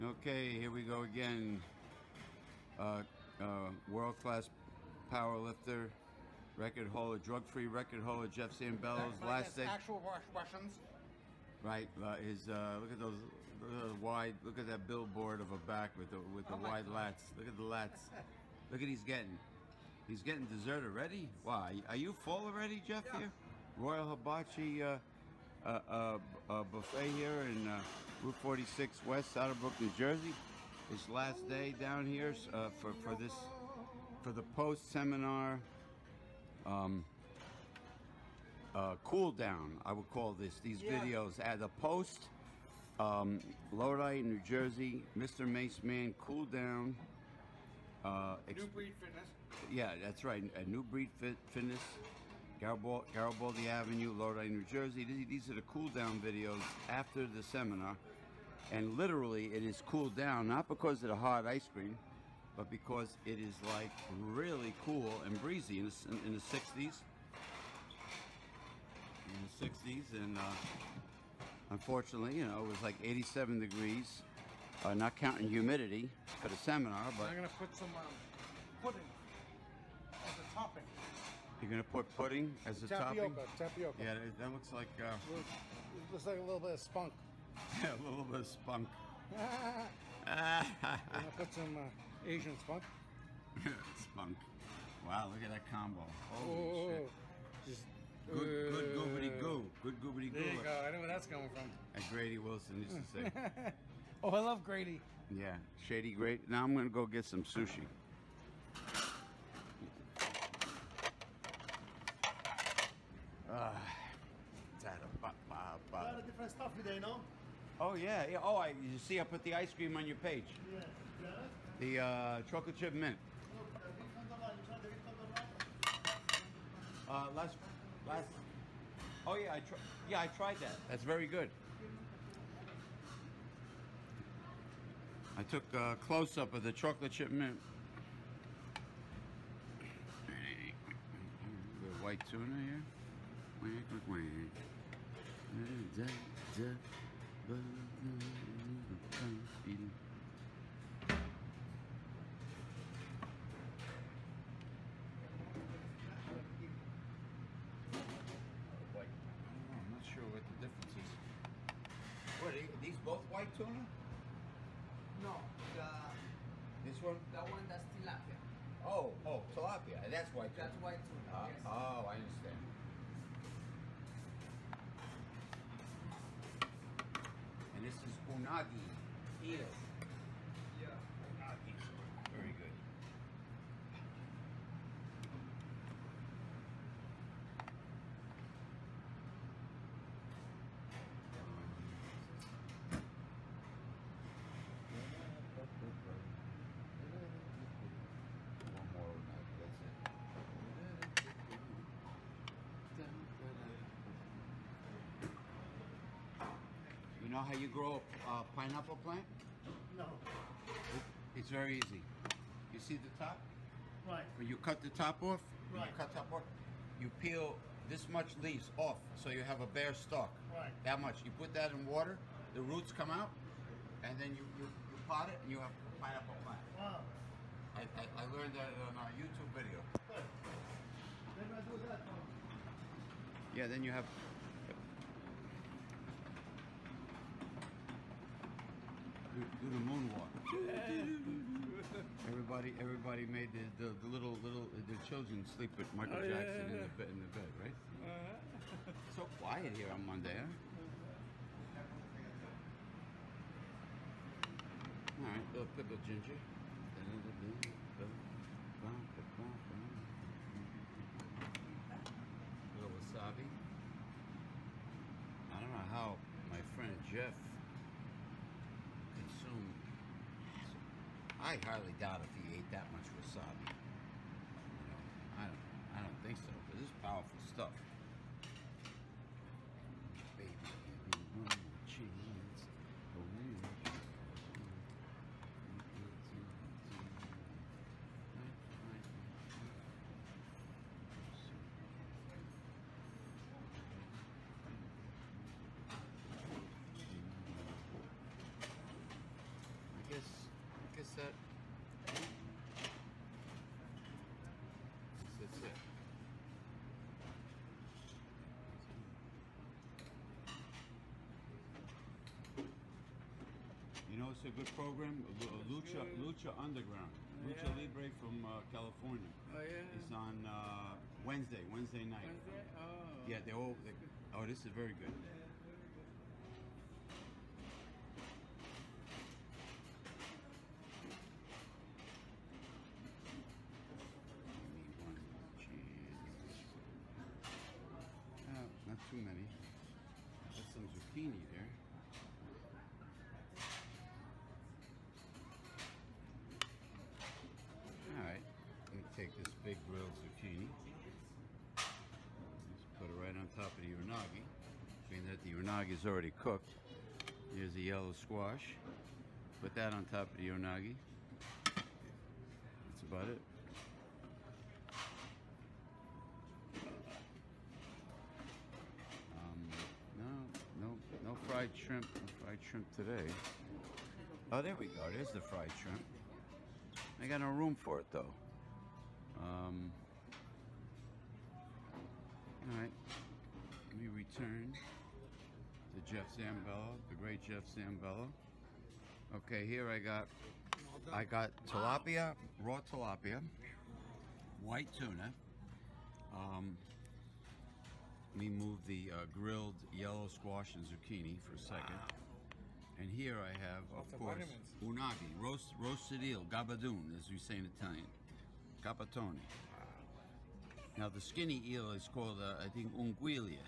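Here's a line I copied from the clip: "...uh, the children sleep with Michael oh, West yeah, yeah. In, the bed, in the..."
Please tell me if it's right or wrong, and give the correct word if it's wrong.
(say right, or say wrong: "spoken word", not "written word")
wrong: "Jackson", not "West".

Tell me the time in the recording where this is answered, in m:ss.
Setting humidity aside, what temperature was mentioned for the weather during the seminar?
1:13.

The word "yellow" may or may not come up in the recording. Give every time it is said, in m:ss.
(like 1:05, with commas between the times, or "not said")
5:57, 6:39.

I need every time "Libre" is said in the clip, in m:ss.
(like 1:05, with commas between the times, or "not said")
5:17.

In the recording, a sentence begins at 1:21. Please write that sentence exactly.
You're gonna put pudding as a tapioca, topping.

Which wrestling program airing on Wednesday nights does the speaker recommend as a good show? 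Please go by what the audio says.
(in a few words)
Lucha Underground.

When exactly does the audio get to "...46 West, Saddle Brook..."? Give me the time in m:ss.
0:28.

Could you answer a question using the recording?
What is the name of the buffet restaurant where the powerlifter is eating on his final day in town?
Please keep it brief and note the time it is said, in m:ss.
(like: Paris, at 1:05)
Royal Hibachi, at 0:23.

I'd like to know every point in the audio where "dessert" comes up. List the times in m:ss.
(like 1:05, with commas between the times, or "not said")
0:20.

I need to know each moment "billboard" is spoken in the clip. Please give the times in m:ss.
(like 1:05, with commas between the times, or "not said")
0:14.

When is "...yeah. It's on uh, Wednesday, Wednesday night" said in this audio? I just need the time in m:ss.
5:19.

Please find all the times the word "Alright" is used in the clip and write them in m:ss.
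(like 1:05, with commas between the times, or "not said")
5:48.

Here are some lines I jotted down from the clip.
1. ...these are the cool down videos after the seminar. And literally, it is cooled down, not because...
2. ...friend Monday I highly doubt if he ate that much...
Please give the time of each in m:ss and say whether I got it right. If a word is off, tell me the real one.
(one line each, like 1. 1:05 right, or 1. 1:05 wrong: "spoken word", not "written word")
1. 0:55 right
2. 4:26 wrong: "Jeff", not "Monday".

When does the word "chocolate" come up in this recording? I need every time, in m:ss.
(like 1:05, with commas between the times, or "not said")
2:02, 2:16.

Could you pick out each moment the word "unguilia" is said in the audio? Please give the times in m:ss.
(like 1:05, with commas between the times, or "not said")
6:52.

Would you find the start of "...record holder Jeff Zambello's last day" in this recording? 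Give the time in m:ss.
0:07.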